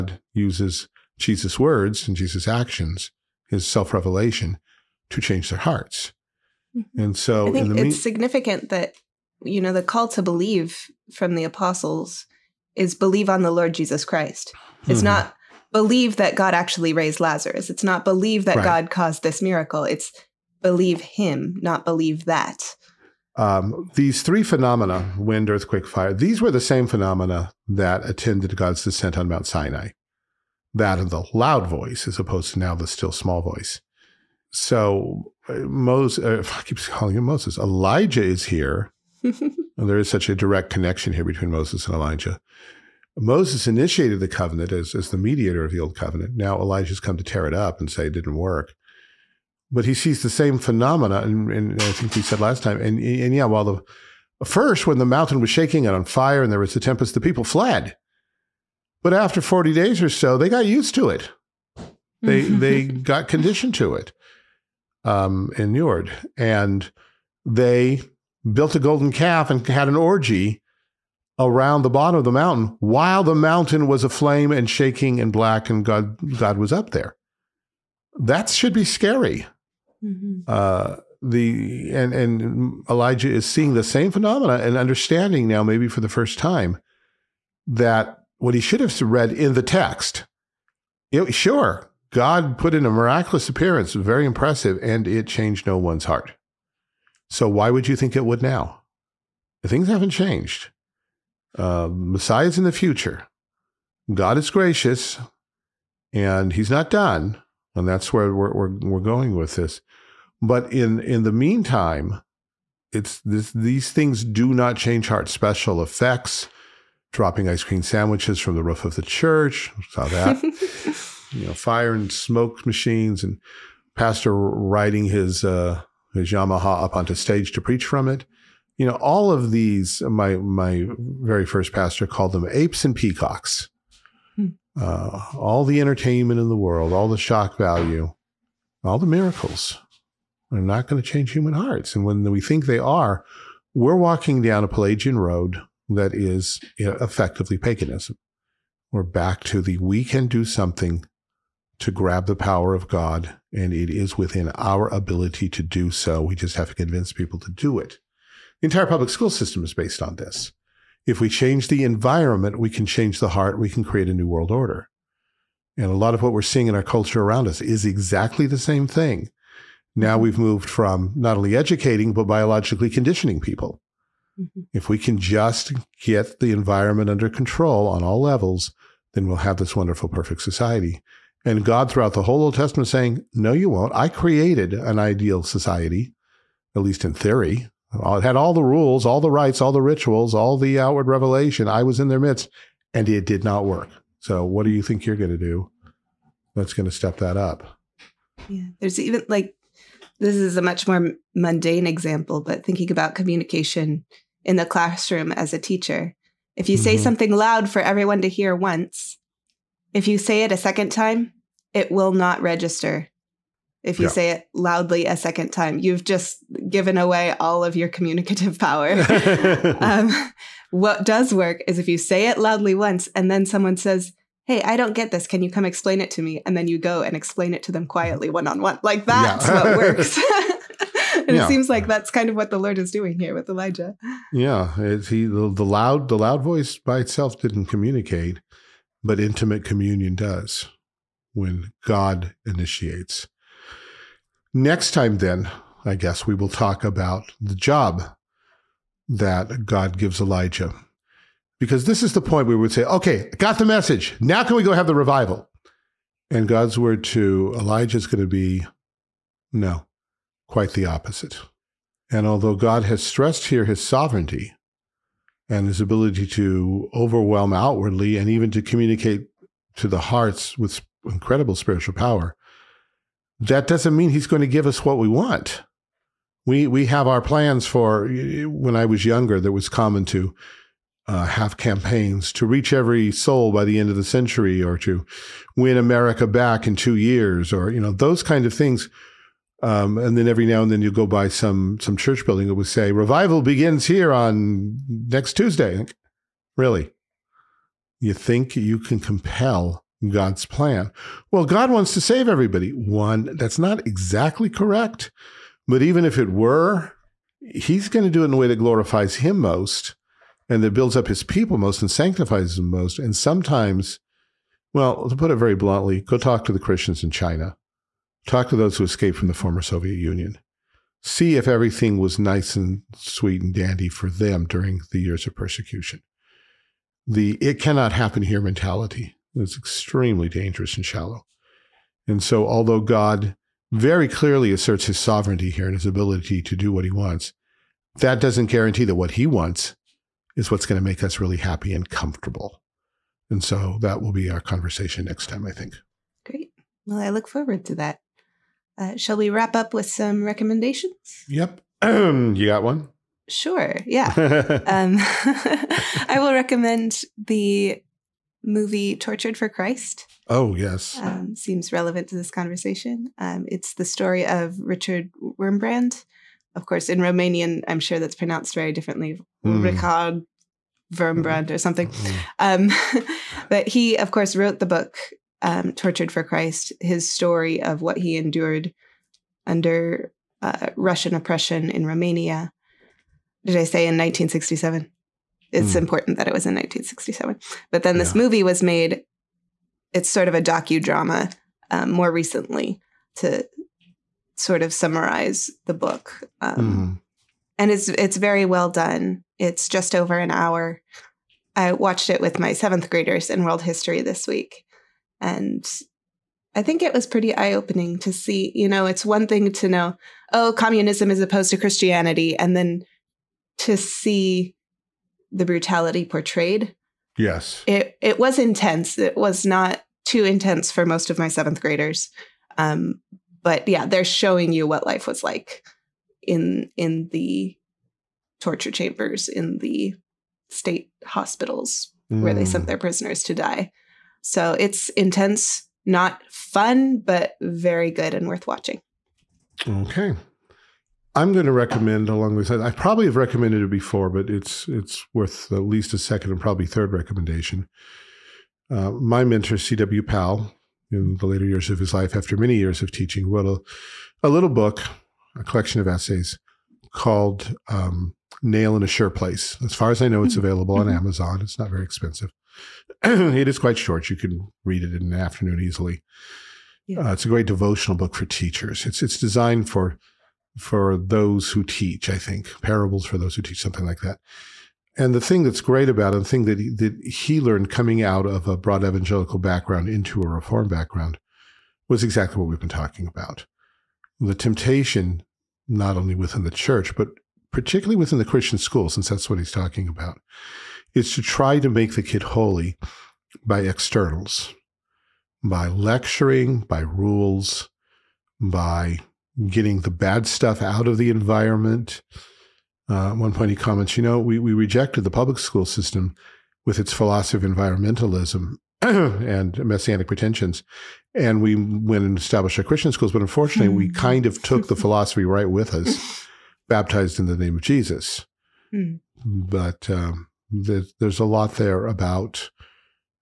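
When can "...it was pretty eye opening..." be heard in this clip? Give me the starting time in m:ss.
6:46.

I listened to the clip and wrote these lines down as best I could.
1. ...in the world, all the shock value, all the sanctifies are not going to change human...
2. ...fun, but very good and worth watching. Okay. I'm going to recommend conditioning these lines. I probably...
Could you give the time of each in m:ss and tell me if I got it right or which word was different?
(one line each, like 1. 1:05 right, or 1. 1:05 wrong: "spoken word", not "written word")
1. 2:16 wrong: "miracles", not "sanctifies"
2. 7:16 wrong: "along", not "conditioning".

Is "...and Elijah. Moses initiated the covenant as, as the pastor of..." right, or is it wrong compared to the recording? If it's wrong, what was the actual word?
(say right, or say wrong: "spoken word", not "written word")
wrong: "mediator", not "pastor".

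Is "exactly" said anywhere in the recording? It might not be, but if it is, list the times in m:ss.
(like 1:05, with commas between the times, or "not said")
2:47, 5:03, 8:02.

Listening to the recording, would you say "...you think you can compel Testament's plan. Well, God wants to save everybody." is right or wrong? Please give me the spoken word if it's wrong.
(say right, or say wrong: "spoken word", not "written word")
wrong: "God", not "Testament".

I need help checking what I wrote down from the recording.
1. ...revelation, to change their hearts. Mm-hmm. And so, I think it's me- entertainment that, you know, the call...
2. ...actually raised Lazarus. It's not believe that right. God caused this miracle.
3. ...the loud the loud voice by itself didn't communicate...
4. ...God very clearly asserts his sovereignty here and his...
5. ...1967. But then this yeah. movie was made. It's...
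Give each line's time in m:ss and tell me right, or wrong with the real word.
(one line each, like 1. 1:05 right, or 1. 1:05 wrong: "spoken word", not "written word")
1. 0:03 wrong: "significant", not "entertainment"
2. 0:16 right
3. 3:55 right
4. 5:32 right
5. 6:26 right.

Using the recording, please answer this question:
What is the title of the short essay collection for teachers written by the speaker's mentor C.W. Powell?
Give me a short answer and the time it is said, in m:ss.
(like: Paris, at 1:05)
Nail in a Sure Place, at 7:38.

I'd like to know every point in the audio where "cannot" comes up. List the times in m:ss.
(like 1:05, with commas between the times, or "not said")
5:27.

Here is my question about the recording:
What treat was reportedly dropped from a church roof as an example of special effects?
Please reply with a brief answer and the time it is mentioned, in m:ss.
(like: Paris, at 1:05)
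Ice cream sandwiches, at 1:57.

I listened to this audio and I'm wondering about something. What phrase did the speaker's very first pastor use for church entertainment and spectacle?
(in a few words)
Apes and peacocks.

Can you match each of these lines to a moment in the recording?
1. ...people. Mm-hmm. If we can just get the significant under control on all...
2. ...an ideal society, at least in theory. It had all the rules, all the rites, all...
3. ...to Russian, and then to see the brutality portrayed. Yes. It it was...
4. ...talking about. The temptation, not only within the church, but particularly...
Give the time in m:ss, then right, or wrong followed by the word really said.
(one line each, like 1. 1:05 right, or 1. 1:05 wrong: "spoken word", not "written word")
1. 2:53 wrong: "environment", not "significant"
2. 3:04 right
3. 6:51 wrong: "Christianity", not "Russian"
4. 8:02 right.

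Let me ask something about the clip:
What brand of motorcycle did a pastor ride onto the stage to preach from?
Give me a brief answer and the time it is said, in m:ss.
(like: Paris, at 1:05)
Yamaha, at 2:06.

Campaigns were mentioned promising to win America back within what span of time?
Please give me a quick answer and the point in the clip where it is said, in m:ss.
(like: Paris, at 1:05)
Two years, at 4:46.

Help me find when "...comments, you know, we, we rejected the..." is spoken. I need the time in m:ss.
8:23.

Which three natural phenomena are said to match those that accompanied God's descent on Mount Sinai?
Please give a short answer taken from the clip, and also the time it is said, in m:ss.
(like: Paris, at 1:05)
Wind, earthquake, fire, at 0:25.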